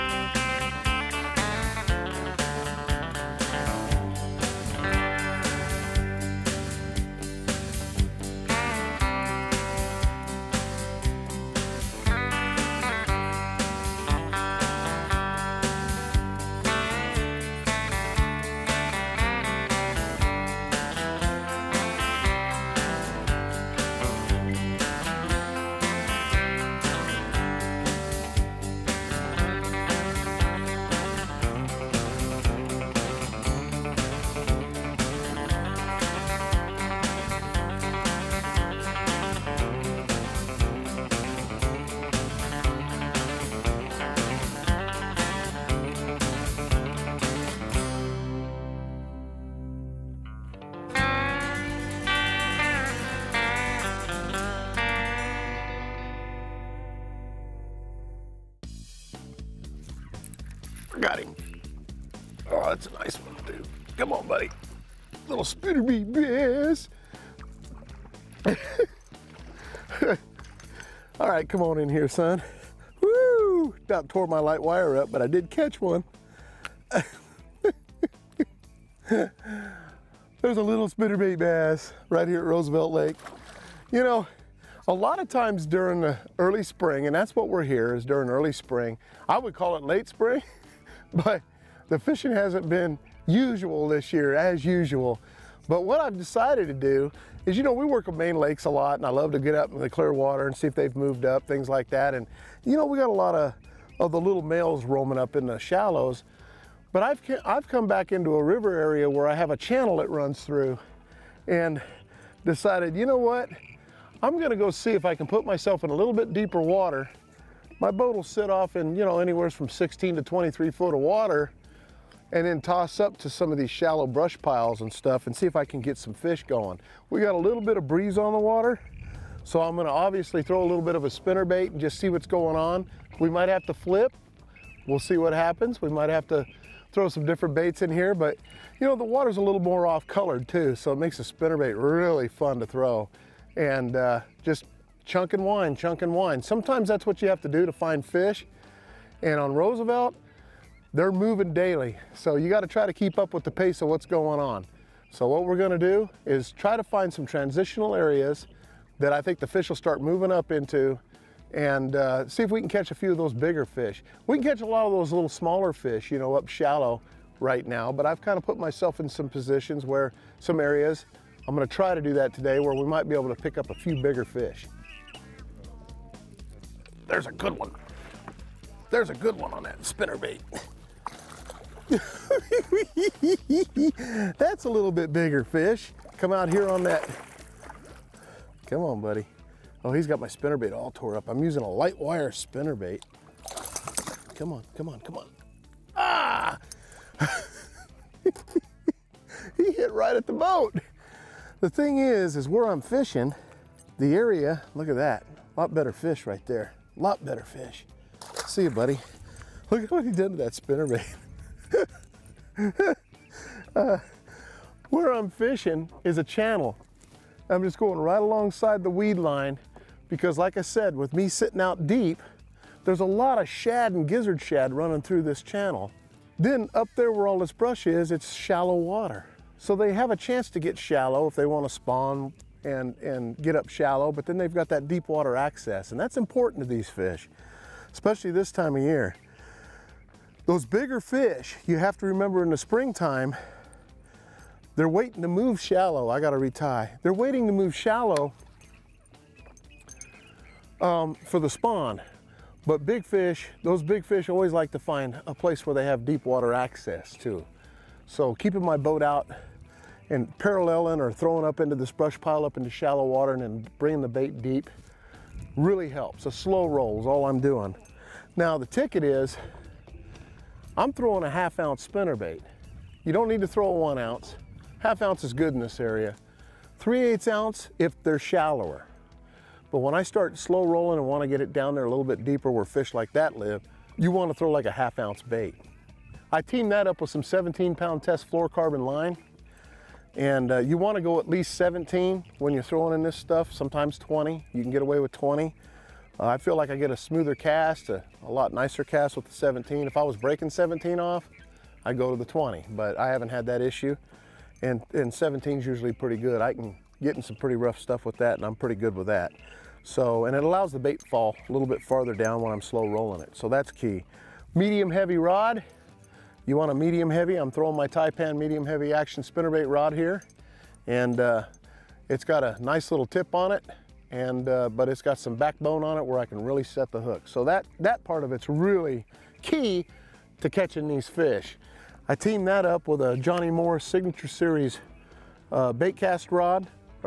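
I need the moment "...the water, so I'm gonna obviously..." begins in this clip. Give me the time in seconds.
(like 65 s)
128 s.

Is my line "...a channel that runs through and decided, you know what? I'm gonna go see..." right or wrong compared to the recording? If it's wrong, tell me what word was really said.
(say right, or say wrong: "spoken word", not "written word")
right.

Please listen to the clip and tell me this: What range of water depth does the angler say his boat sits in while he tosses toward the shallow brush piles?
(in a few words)
16 to 23 feet.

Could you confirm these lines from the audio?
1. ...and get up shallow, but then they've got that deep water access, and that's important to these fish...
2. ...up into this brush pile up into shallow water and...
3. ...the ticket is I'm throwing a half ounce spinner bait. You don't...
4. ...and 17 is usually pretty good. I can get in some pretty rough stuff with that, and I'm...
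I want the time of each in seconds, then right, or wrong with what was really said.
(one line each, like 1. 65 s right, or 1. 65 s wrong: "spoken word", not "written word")
1. 232 s right
2. 261 s right
3. 268 s right
4. 304 s right.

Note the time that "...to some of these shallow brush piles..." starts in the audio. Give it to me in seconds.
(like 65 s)
123 s.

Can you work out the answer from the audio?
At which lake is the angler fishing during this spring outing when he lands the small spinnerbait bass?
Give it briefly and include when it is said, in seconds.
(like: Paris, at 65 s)
Roosevelt Lake, at 82 s.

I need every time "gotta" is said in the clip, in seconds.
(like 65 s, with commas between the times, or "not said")
152 s, 246 s.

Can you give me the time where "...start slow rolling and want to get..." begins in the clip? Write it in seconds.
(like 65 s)
280 s.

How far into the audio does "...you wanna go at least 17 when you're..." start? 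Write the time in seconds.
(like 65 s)
290 s.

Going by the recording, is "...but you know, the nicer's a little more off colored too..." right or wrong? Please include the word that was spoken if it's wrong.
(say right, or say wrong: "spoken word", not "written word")
wrong: "water", not "nicer".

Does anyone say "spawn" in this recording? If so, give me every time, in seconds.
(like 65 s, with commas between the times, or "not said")
231 s, 251 s.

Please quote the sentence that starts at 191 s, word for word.
I'm using a light wire spinner bait.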